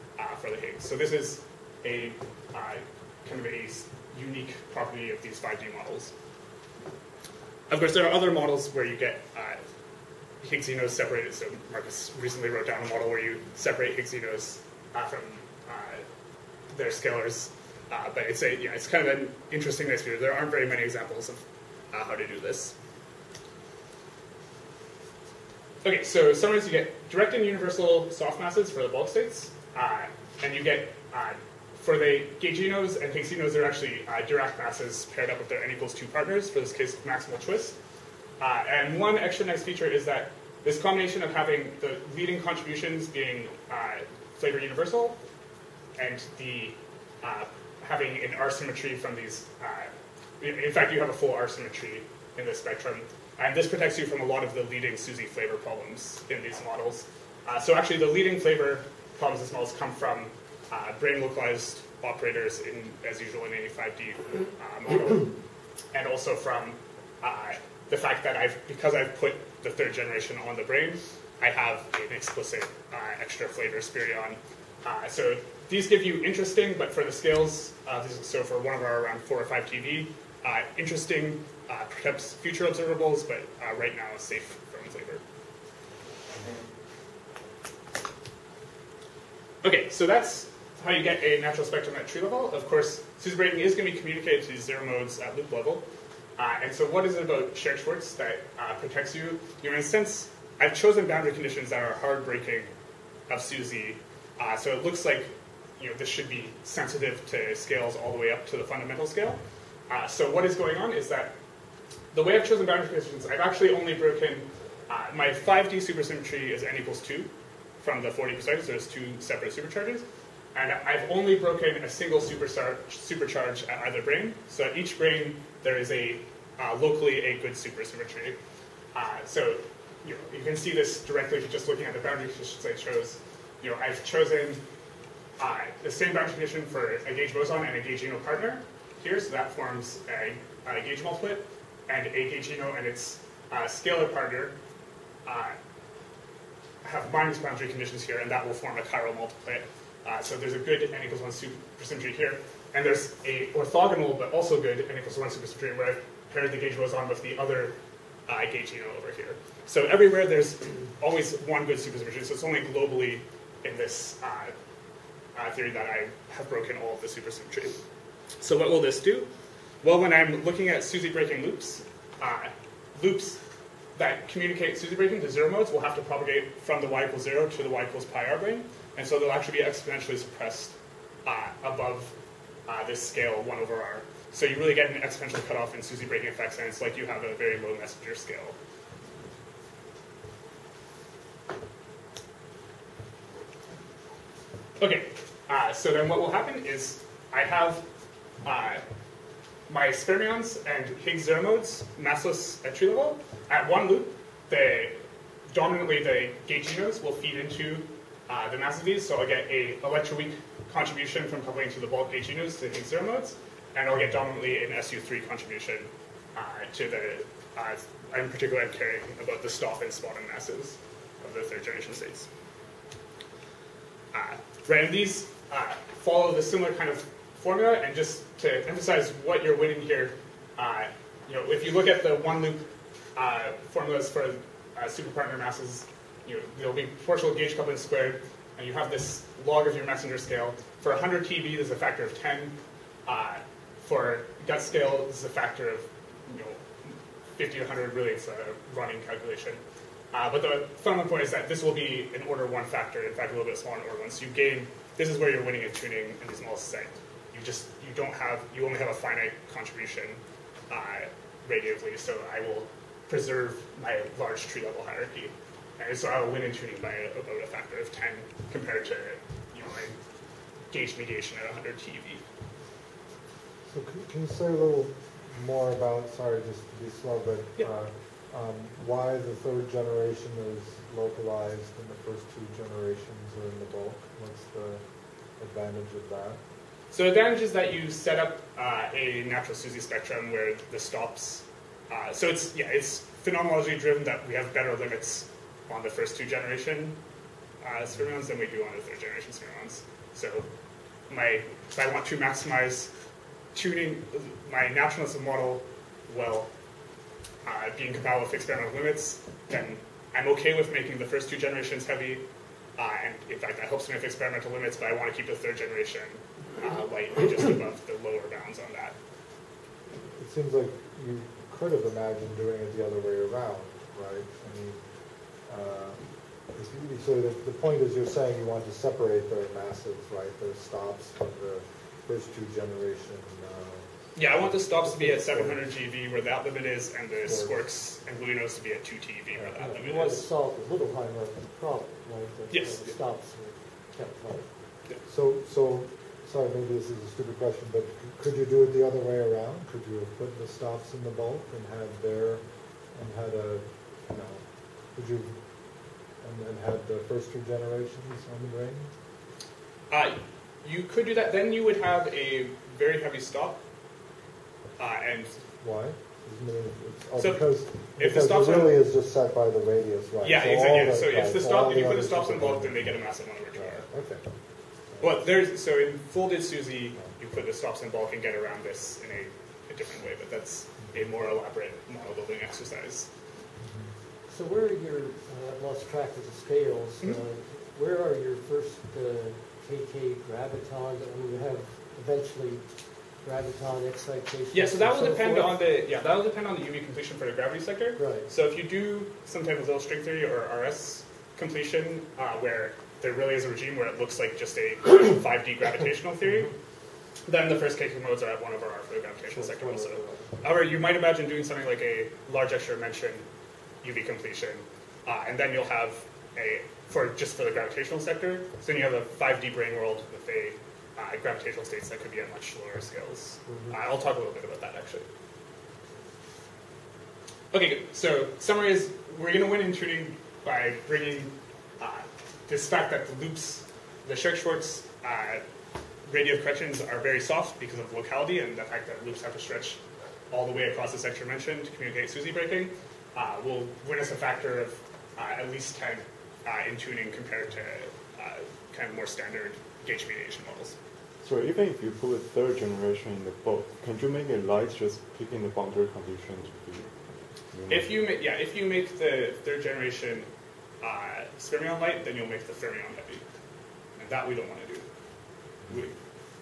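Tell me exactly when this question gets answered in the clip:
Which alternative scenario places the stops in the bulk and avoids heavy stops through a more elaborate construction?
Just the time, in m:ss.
6:16.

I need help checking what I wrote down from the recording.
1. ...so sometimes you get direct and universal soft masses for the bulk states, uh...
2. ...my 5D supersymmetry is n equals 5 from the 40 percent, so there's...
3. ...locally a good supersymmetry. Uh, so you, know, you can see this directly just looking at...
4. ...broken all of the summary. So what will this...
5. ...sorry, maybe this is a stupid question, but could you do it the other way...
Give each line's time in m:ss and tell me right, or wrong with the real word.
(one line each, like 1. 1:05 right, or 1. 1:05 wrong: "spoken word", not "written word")
1. 0:26 right
2. 1:55 wrong: "2", not "5"
3. 2:06 right
4. 2:46 wrong: "supersymmetry", not "summary"
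5. 5:46 right.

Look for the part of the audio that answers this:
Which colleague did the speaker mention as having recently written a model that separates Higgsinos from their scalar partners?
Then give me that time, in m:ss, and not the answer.
0:11.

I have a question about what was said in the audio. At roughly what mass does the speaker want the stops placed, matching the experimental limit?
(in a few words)
700 GeV.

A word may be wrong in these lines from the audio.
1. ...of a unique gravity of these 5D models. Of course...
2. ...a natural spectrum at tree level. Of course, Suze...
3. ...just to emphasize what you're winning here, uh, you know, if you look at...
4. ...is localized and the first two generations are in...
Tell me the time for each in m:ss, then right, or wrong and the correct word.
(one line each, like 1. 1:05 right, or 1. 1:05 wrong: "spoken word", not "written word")
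1. 0:03 wrong: "property", not "gravity"
2. 1:31 right
3. 3:47 right
4. 4:40 right.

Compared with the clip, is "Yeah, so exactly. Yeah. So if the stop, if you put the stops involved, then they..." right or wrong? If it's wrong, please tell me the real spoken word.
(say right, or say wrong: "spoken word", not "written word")
right.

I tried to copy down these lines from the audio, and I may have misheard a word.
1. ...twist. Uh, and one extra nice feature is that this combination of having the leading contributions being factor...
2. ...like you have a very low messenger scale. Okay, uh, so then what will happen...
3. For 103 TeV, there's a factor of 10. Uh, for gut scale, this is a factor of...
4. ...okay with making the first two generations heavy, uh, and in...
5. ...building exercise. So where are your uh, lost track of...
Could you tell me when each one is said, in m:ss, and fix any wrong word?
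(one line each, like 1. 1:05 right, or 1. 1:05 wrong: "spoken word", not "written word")
1. 0:37 wrong: "flavor", not "factor"
2. 3:06 right
3. 4:00 wrong: "100", not "103"
4. 5:10 right
5. 6:22 right.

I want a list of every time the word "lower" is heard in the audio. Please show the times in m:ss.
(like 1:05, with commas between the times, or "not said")
5:18, 7:02.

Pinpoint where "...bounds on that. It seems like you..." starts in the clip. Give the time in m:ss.
5:18.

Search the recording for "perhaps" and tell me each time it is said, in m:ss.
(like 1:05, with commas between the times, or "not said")
1:21.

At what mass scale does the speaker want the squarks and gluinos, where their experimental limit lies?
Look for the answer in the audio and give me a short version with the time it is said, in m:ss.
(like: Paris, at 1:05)
2 TeV, at 5:38.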